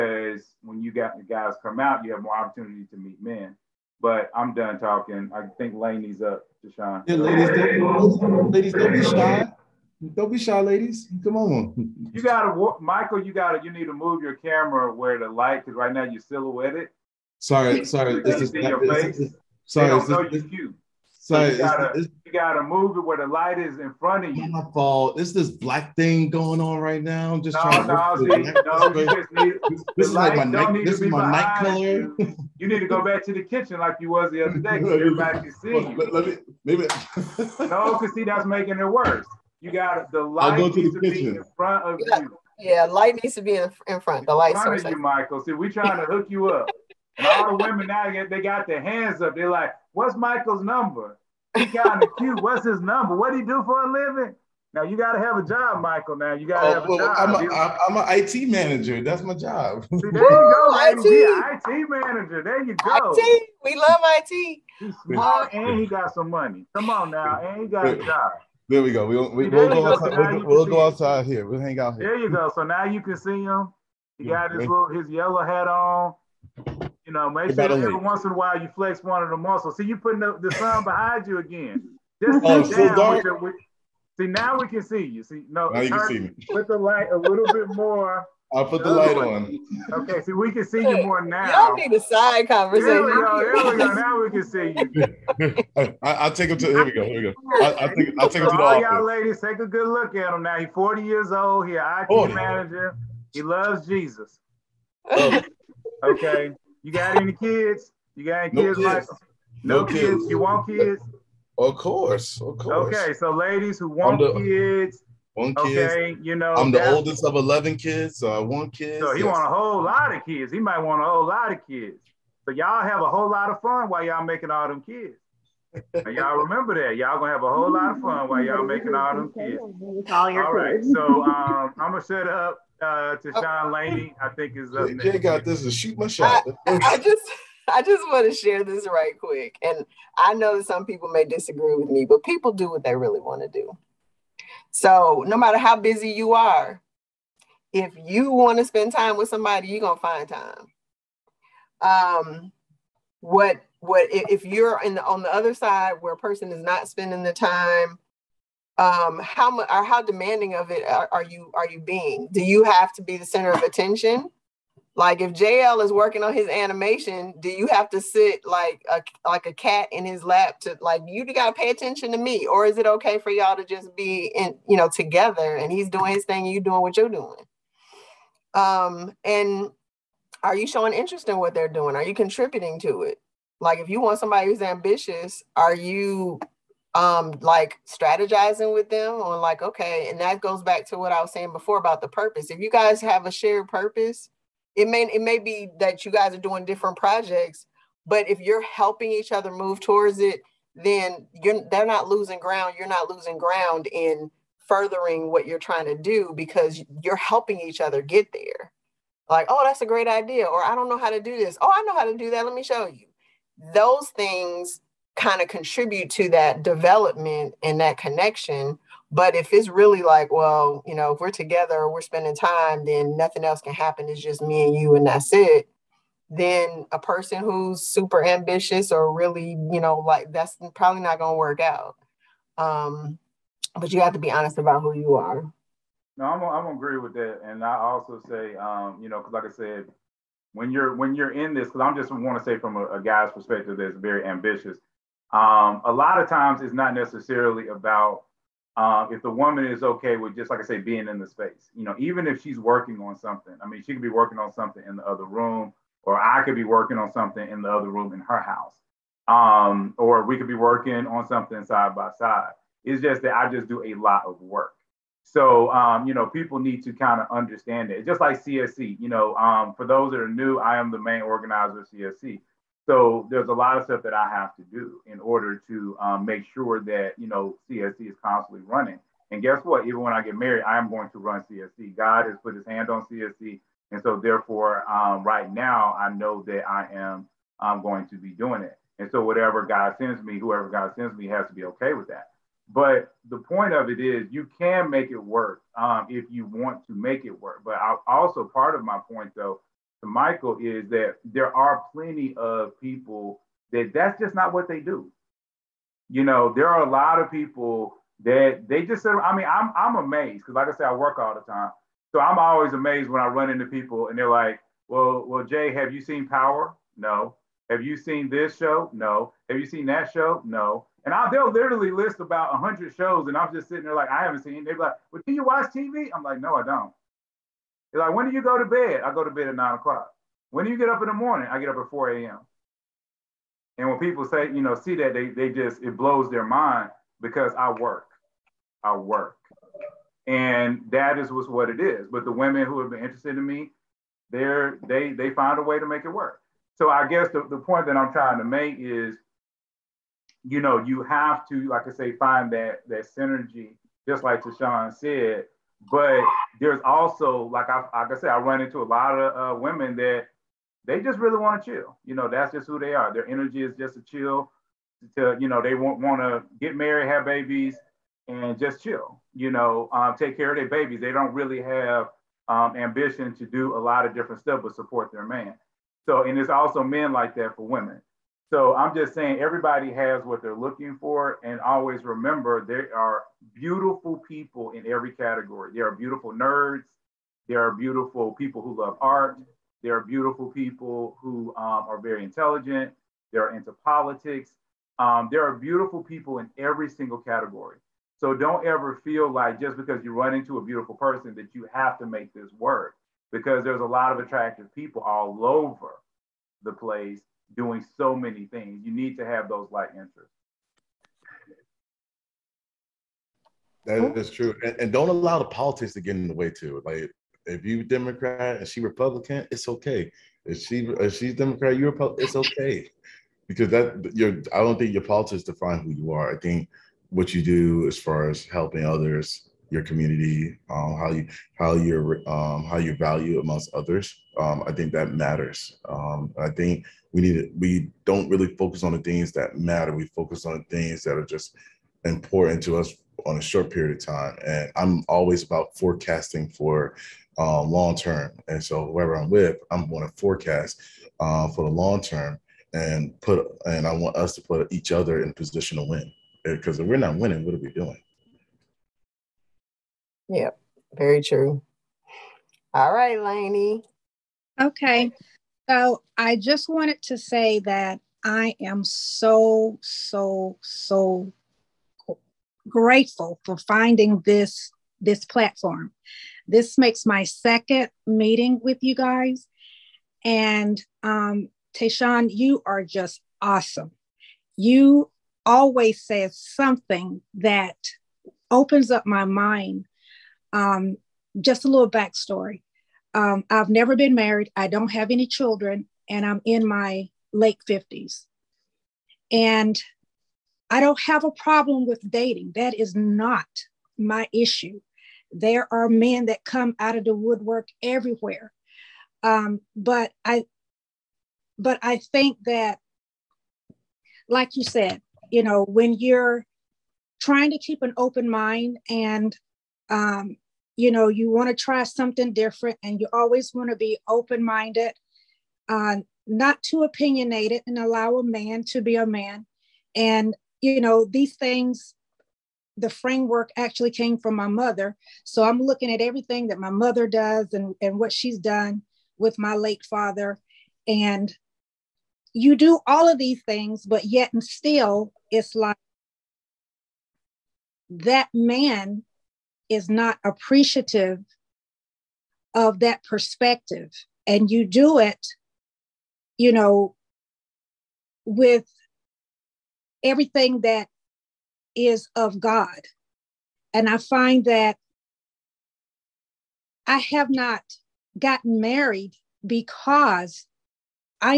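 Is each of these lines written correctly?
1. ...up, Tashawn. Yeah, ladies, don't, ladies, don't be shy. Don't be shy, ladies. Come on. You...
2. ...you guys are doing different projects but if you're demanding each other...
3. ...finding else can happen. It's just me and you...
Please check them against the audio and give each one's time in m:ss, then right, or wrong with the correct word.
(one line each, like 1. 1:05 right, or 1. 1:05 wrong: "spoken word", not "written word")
1. 0:06 right
2. 3:16 wrong: "helping", not "demanding"
3. 3:43 wrong: "nothing", not "finding".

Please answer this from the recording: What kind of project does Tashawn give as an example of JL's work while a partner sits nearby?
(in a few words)
animation.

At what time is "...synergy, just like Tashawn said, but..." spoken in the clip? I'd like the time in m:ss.
5:53.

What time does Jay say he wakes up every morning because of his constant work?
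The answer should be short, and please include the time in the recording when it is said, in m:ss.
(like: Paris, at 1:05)
4 a.m., at 5:31.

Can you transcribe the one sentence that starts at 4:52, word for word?
But the point of it is, you can make it work um, if you want to make it work.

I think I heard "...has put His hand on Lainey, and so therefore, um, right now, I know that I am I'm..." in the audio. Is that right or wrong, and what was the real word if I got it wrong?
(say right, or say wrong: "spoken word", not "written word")
wrong: "CSC", not "Lainey".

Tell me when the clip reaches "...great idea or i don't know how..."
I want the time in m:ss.
3:29.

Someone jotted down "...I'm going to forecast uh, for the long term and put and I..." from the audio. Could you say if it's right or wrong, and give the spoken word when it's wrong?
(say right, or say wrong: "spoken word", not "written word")
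right.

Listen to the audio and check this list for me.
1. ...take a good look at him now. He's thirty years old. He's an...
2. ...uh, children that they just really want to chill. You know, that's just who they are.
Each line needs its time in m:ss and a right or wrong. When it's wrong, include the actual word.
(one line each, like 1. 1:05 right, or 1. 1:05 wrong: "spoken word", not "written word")
1. 1:39 wrong: "forty", not "thirty"
2. 5:59 wrong: "women", not "children".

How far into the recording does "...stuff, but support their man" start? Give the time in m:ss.
6:14.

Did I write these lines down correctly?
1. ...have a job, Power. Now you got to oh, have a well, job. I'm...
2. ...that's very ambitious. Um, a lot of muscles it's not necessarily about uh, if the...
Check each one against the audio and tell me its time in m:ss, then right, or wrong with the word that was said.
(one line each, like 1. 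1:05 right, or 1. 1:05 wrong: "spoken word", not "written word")
1. 0:55 wrong: "Michael", not "Power"
2. 4:03 wrong: "times", not "muscles".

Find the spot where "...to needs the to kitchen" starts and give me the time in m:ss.
0:40.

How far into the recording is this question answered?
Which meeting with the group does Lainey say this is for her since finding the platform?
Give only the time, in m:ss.
7:57.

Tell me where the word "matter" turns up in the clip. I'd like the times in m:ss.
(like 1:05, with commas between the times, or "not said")
2:25, 7:15, 7:19.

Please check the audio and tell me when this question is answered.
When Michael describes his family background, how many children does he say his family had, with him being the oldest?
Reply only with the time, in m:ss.
1:57.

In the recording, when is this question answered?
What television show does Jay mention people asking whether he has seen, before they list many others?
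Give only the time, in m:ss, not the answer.
5:16.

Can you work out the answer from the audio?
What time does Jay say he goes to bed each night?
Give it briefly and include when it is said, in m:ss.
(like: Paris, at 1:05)
9 o'clock, at 5:29.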